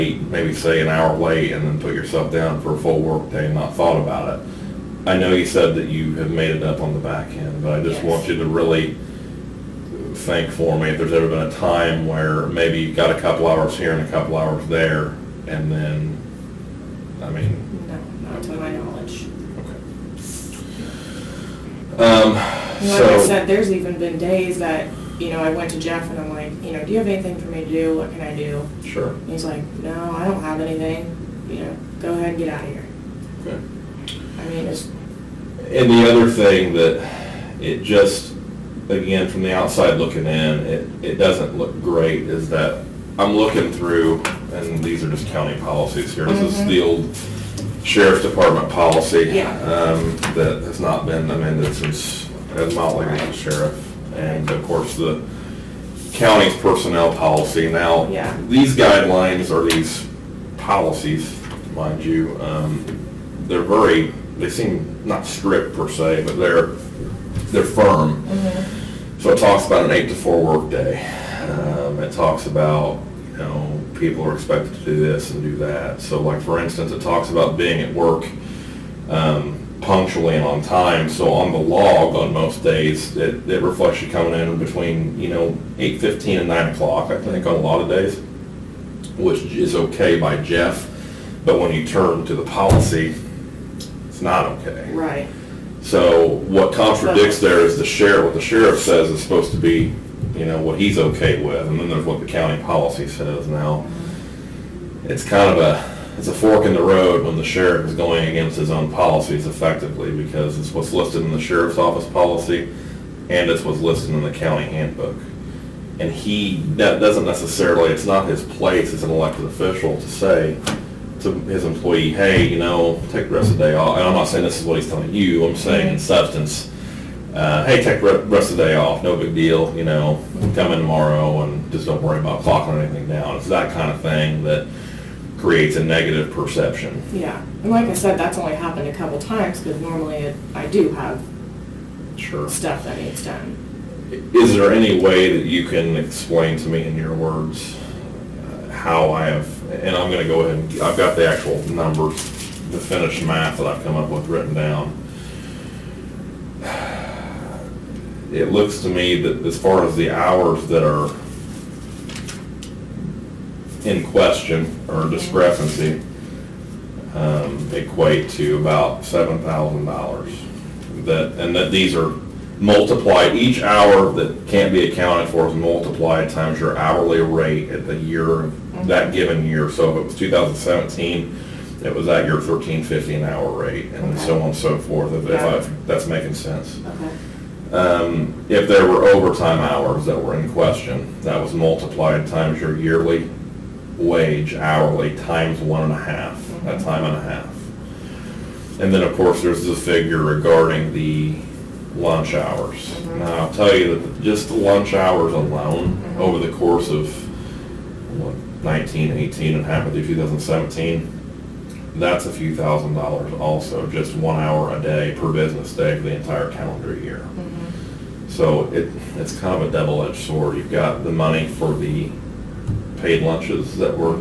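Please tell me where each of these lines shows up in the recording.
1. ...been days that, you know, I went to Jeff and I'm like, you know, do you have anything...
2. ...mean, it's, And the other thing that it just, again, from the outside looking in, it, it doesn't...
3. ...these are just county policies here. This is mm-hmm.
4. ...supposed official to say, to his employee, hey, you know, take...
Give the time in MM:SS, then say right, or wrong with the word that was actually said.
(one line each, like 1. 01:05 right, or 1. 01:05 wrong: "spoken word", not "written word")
1. 00:23 right
2. 00:34 right
3. 00:44 right
4. 01:59 wrong: "elected", not "supposed".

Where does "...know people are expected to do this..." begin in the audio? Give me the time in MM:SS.
01:13.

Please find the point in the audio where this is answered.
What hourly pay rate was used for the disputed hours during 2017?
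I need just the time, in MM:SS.
03:02.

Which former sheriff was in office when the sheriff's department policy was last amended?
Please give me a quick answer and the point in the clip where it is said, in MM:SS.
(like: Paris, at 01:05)
Ed Motley, at 00:52.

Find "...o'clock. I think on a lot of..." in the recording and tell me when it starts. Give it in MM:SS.
01:26.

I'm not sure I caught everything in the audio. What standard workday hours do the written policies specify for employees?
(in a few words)
8 to 4.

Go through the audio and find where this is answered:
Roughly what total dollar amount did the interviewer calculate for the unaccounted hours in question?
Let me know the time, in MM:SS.
02:49.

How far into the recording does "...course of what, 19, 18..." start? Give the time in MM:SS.
03:26.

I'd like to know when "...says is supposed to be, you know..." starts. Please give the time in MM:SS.
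01:38.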